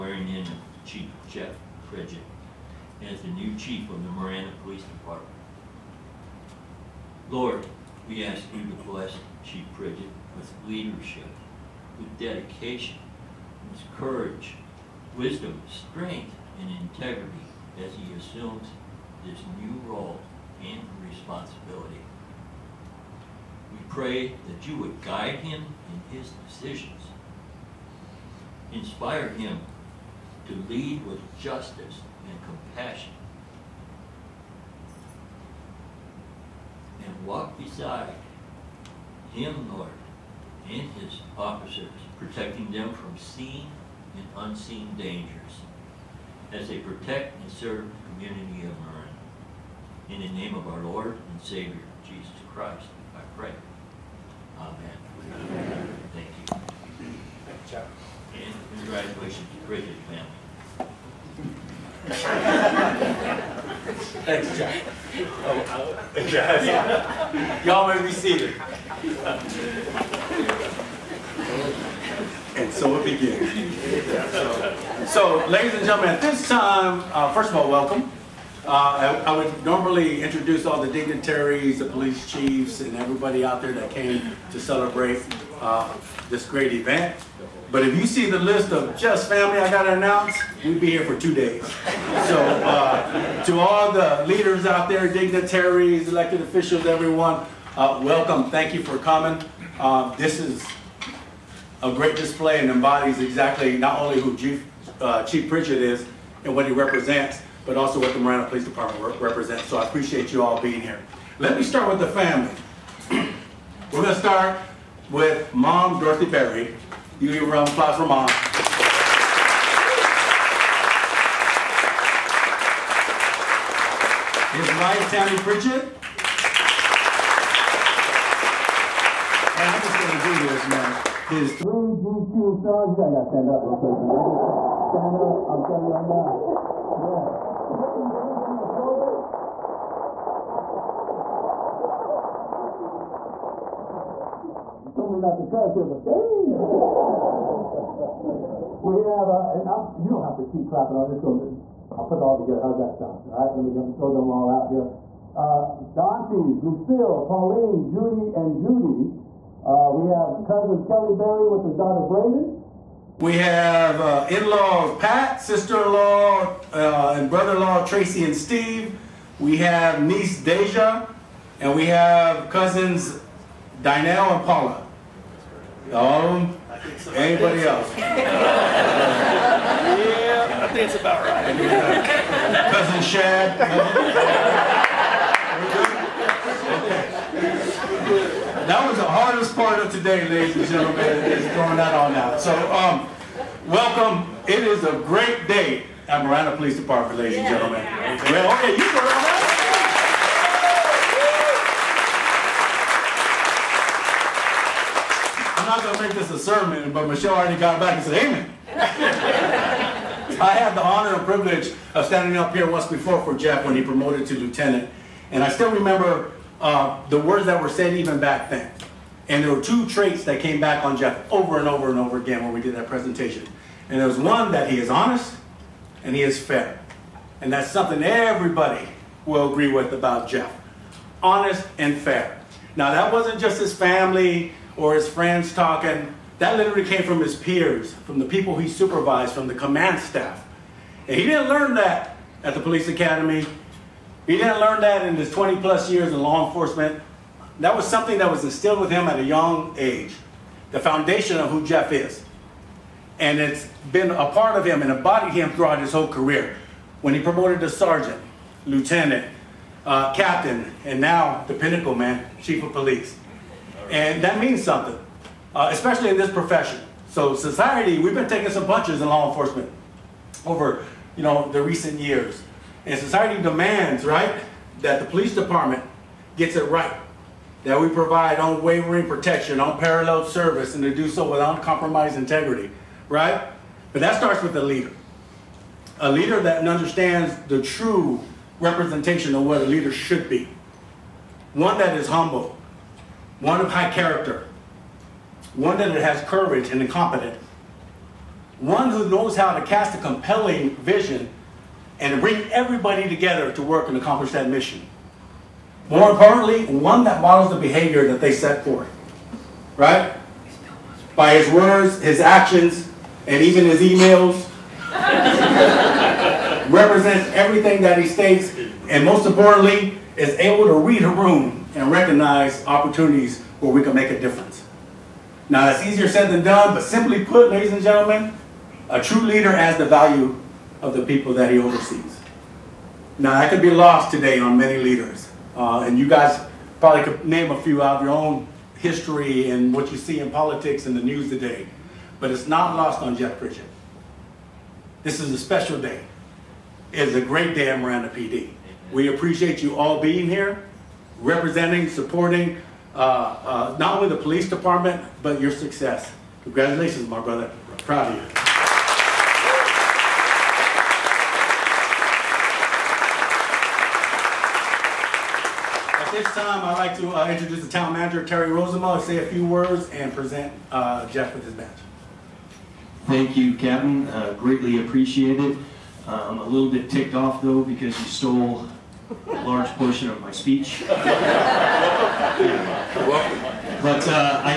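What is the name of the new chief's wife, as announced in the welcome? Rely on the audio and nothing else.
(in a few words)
Tammy Pritchett.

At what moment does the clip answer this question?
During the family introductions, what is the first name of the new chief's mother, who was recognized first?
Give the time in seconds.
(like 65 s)
115 s.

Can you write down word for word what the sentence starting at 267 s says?
So society, we've been taking some punches in law enforcement over, you know, the recent years.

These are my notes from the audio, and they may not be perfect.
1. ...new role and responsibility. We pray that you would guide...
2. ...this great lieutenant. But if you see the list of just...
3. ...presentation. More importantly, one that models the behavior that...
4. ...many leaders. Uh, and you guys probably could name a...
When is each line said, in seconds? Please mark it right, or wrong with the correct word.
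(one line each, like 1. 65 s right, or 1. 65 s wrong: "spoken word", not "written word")
1. 19 s right
2. 86 s wrong: "event", not "lieutenant"
3. 304 s wrong: "mission", not "presentation"
4. 334 s right.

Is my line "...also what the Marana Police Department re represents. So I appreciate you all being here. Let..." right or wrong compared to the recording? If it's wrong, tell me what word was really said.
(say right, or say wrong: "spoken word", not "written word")
right.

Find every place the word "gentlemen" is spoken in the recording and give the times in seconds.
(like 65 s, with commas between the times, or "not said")
75 s, 190 s, 197 s, 327 s.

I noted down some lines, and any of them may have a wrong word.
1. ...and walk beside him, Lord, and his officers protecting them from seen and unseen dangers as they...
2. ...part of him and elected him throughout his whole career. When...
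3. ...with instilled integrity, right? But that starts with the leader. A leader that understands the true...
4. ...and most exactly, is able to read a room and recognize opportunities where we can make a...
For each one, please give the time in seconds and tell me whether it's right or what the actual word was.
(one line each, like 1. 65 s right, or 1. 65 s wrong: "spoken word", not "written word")
1. 37 s right
2. 254 s wrong: "embodied", not "elected"
3. 281 s wrong: "uncompromised", not "instilled"
4. 318 s wrong: "importantly", not "exactly".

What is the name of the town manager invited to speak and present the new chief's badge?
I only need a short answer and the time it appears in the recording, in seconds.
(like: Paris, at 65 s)
Terry Rozema, at 368 s.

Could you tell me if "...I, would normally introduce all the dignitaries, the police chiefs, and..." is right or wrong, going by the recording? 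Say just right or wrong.
right.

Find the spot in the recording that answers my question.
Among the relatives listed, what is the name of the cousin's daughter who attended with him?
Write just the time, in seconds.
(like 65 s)
162 s.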